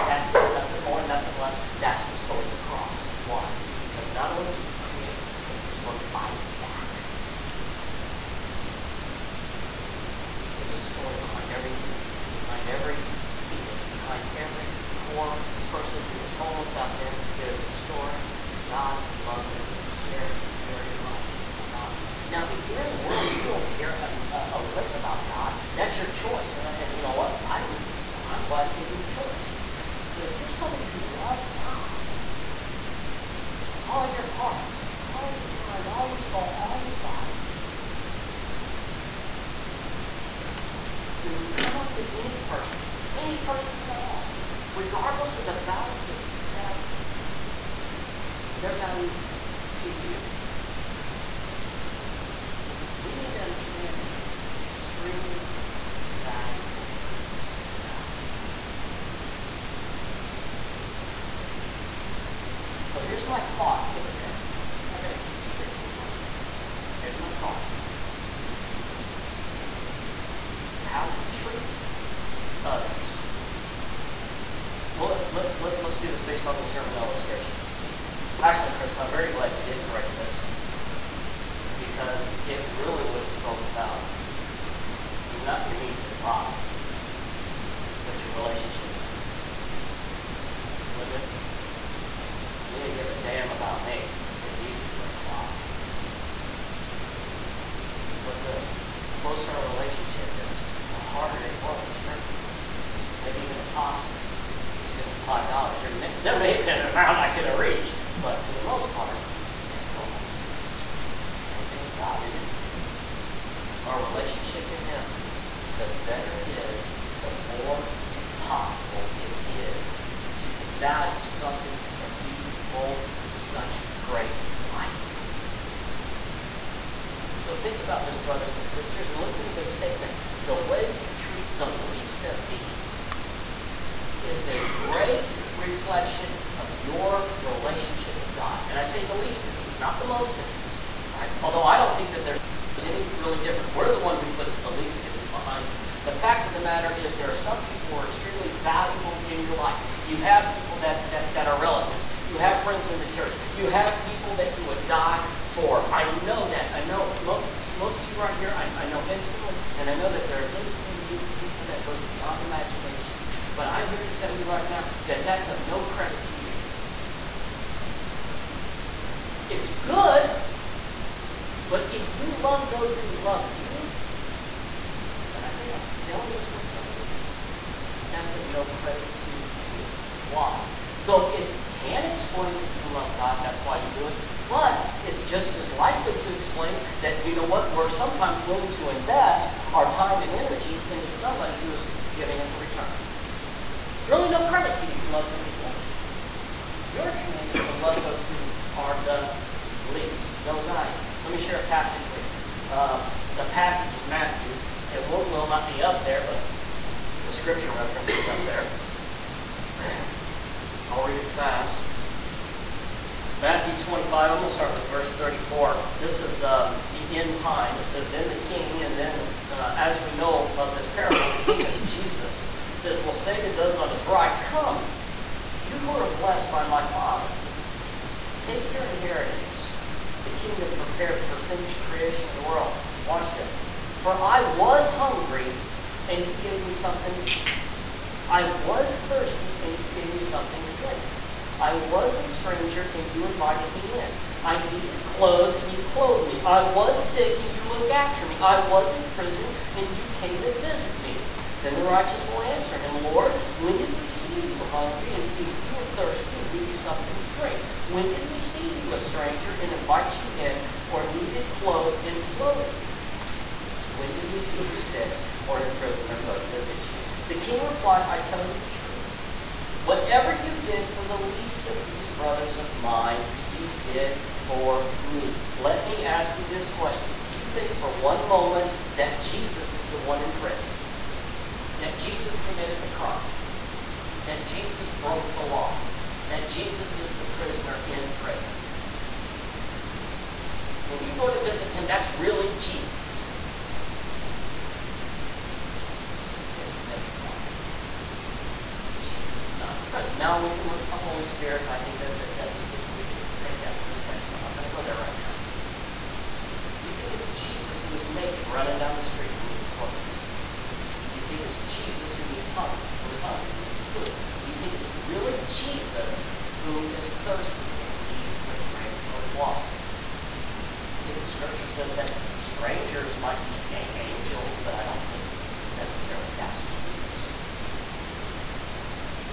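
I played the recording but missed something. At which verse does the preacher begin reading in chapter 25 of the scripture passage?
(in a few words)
34.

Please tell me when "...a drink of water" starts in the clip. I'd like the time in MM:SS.
05:18.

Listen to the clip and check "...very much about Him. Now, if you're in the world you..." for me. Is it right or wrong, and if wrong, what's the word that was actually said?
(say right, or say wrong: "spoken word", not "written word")
right.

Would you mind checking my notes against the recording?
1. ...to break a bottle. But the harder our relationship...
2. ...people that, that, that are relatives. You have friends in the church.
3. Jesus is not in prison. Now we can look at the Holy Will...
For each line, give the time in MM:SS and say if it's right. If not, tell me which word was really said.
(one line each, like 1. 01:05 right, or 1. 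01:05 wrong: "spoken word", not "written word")
1. 01:34 wrong: "closer", not "harder"
2. 02:30 right
3. 04:59 wrong: "Spirit", not "Will".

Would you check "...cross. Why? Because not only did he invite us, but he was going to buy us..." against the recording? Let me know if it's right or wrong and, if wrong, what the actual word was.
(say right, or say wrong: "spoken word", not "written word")
wrong: "create", not "invite".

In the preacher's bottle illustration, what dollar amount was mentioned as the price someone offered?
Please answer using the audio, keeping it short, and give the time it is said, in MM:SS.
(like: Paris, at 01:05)
$5, at 01:45.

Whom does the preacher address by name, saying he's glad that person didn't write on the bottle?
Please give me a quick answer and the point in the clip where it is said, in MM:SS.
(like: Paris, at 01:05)
Chris, at 01:18.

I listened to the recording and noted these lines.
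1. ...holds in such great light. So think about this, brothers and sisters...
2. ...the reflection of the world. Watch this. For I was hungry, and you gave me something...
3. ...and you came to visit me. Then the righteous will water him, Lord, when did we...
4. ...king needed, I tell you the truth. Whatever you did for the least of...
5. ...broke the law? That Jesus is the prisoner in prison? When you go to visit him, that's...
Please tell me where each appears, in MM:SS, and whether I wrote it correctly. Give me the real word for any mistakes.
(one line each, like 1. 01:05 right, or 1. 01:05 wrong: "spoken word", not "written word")
1. 02:02 right
2. 03:51 wrong: "creation", not "reflection"
3. 04:09 wrong: "answer", not "water"
4. 04:27 wrong: "replied", not "needed"
5. 04:45 right.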